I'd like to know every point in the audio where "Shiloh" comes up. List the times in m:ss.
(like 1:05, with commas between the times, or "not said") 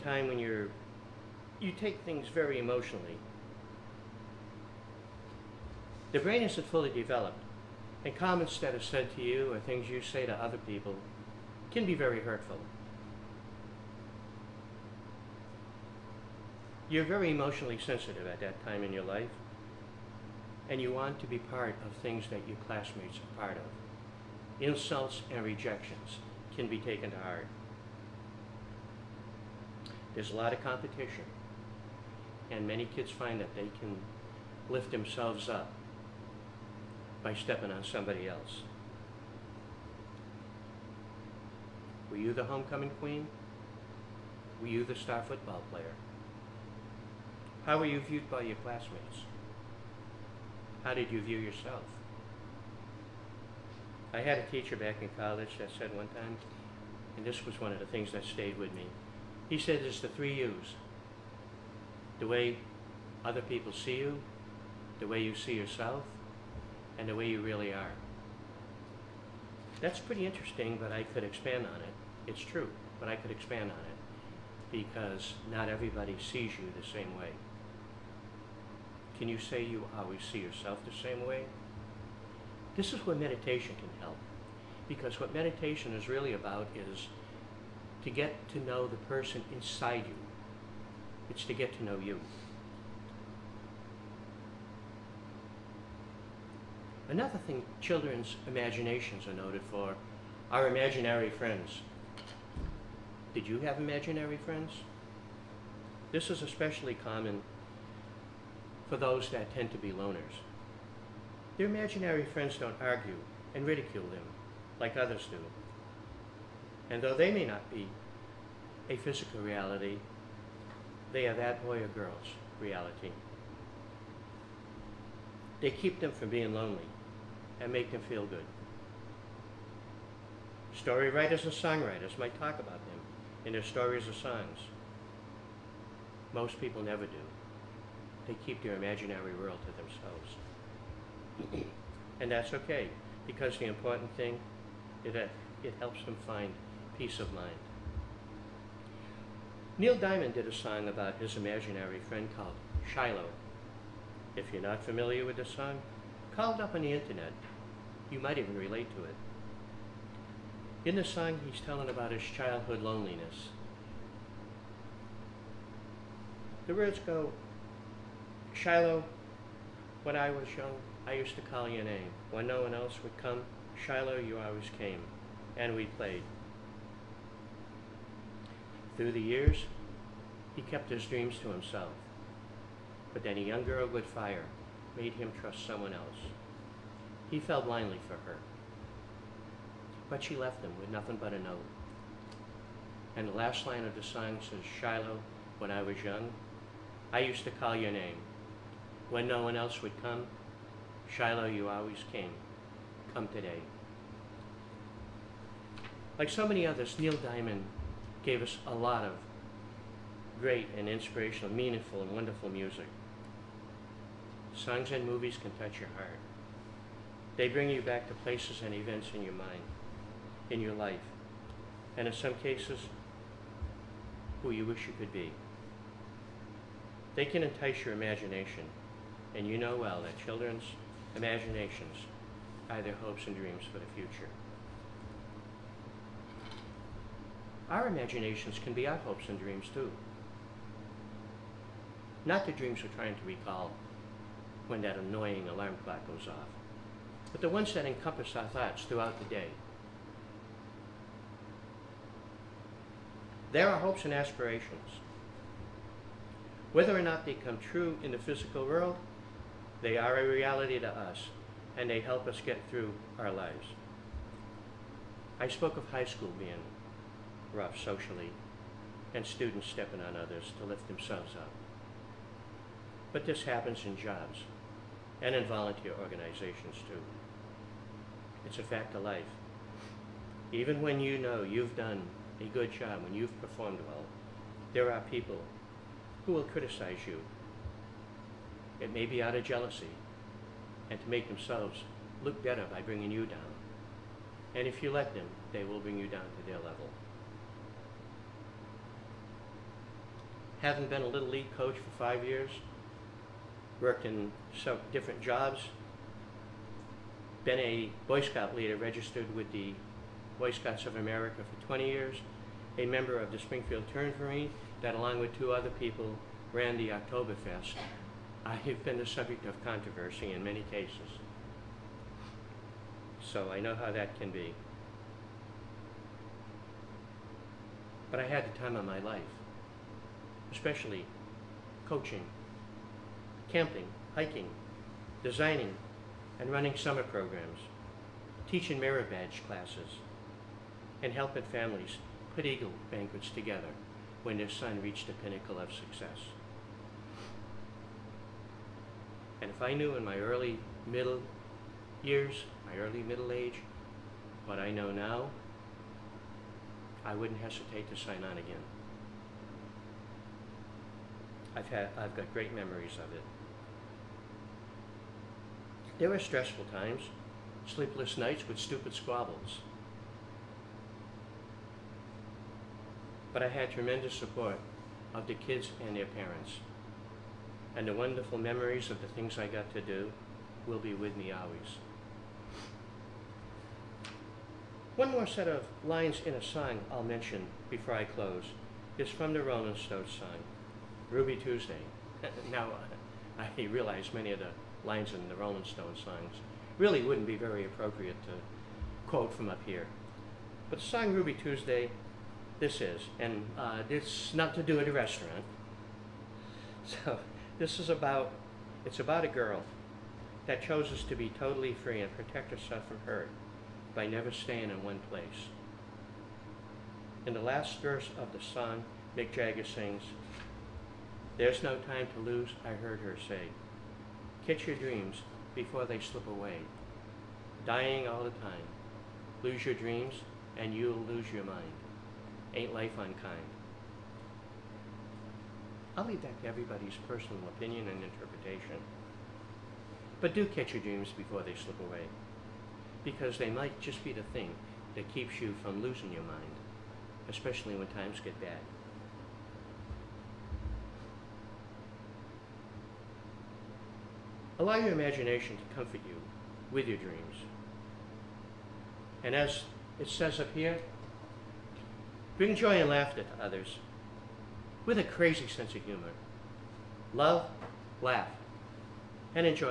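2:32, 2:48, 2:53, 3:14, 3:21.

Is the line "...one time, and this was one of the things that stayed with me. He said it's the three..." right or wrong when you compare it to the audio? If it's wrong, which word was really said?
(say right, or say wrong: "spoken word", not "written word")
right.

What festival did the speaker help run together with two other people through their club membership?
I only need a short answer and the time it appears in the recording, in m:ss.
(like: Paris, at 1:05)
Oktoberfest, at 5:16.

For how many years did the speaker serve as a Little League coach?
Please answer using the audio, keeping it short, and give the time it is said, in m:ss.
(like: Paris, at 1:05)
5 years, at 5:01.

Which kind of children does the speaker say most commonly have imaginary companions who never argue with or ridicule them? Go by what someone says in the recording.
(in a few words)
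Loners.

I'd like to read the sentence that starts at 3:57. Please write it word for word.
Our imaginations can be our hopes and dreams too.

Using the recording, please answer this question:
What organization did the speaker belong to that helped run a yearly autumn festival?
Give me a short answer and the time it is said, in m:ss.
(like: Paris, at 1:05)
Springfield Turnverein, at 5:13.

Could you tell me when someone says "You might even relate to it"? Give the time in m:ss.
2:38.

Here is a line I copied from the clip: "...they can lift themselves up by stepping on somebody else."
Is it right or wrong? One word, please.
right.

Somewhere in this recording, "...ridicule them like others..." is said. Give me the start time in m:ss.
1:53.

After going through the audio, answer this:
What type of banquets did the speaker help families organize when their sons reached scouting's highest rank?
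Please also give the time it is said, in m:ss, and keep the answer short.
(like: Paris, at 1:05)
Eagle banquets, at 5:42.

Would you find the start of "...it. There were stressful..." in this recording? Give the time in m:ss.
6:03.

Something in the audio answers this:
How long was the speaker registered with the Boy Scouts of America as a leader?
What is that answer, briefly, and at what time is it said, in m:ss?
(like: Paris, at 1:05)
20 years, at 5:11.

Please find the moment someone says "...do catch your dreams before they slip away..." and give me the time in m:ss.
7:20.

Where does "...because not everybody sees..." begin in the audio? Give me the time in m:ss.
1:14.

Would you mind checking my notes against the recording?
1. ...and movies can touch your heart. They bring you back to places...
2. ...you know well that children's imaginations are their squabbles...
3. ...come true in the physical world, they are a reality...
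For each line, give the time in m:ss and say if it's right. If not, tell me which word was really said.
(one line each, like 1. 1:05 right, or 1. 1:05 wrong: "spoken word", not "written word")
1. 3:34 right
2. 3:49 wrong: "hopes", not "squabbles"
3. 4:17 right.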